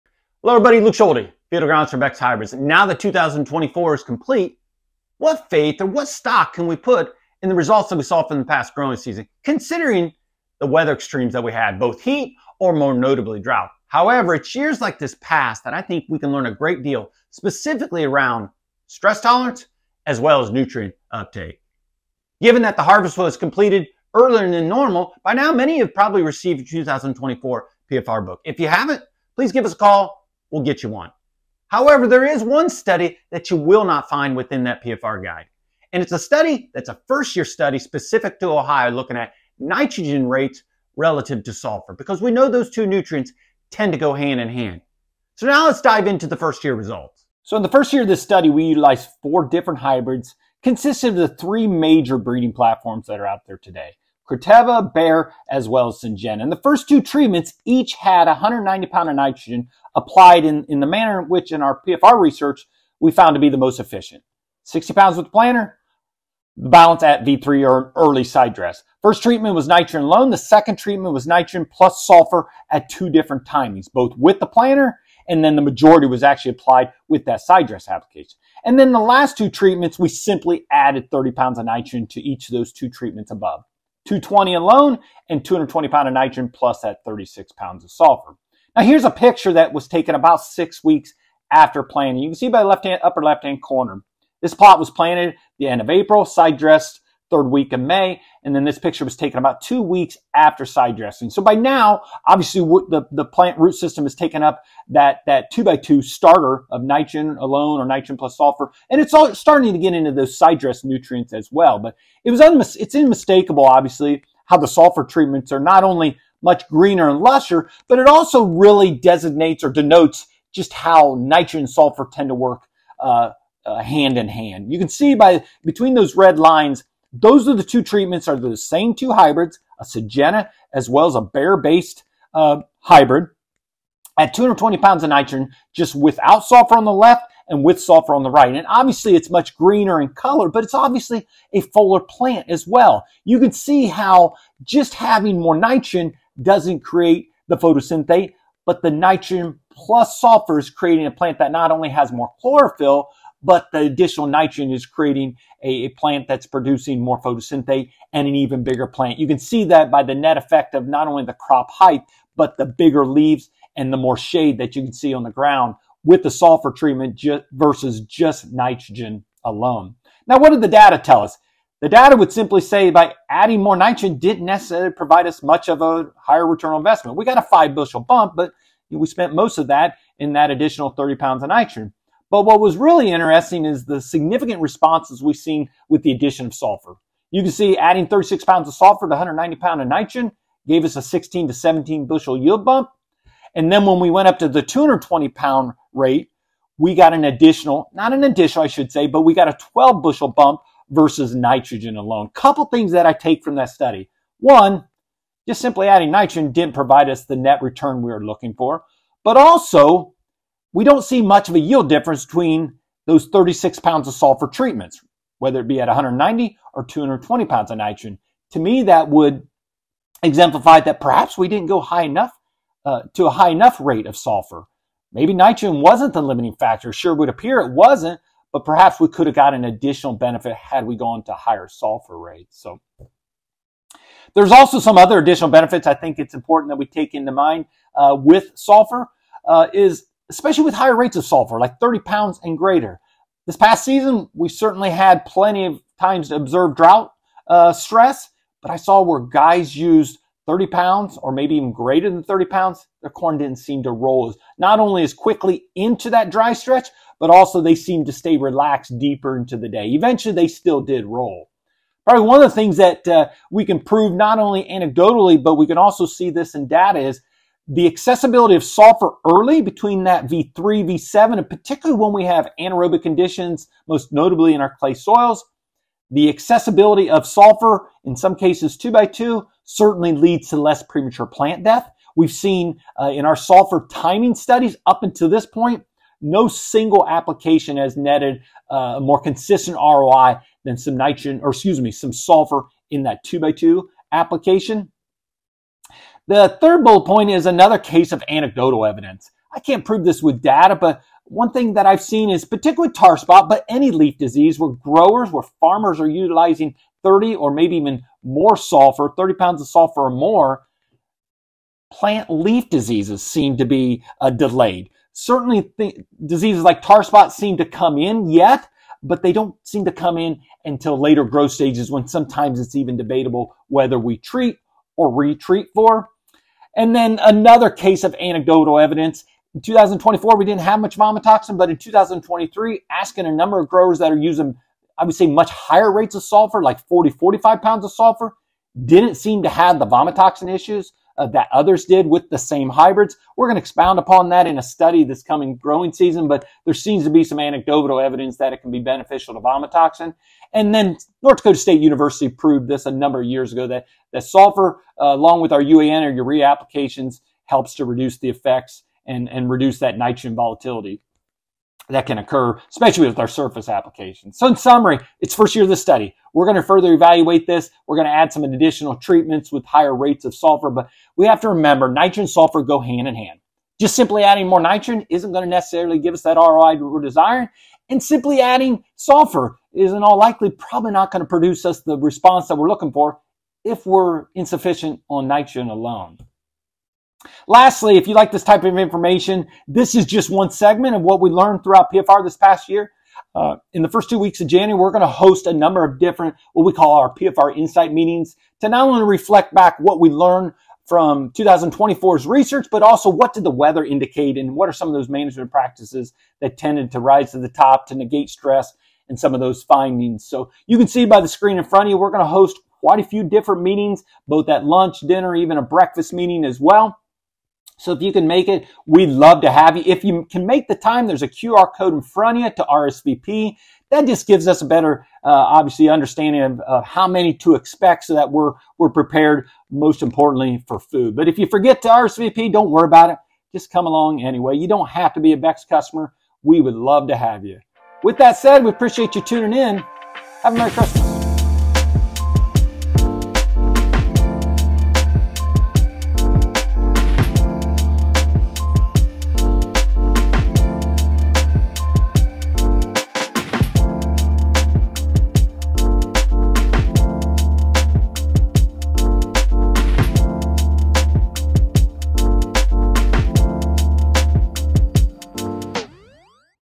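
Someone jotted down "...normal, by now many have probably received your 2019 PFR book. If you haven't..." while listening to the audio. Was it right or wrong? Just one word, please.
wrong.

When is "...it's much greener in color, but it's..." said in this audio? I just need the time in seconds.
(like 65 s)
139 s.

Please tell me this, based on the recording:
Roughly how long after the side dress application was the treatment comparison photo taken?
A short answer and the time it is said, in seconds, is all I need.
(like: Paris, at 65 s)
about two weeks, at 99 s.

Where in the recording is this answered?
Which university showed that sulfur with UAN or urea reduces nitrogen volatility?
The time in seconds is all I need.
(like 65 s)
351 s.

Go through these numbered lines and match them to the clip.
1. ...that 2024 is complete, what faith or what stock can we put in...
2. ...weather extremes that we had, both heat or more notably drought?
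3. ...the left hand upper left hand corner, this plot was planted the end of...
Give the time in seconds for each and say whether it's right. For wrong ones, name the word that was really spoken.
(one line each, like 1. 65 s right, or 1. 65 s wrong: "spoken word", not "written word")
1. 2 s right
2. 10 s right
3. 92 s right.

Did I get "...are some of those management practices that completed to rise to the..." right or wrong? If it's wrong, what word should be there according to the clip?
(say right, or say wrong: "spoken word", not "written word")
wrong: "tended", not "completed".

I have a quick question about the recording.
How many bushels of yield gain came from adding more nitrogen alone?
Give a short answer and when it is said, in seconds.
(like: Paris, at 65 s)
5 bushels, at 177 s.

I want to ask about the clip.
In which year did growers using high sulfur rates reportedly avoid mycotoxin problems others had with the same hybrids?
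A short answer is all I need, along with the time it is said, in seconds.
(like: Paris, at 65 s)
2023, at 331 s.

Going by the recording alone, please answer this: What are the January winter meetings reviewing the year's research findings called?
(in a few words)
PFR Insight meetings.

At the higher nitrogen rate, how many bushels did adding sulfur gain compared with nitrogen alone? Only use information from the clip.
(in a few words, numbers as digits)
12 bushels.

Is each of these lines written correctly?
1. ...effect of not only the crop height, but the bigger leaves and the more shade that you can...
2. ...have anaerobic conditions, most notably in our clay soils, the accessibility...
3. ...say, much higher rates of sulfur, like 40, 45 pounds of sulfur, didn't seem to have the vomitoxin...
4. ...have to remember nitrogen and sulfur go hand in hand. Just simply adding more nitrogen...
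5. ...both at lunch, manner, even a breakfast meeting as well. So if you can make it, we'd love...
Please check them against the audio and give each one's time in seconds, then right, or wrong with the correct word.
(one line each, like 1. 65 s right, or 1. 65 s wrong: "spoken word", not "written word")
1. 160 s right
2. 272 s right
3. 335 s right
4. 371 s right
5. 414 s wrong: "dinner", not "manner".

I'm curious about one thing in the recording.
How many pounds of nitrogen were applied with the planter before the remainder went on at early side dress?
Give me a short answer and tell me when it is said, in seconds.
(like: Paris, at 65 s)
60, at 64 s.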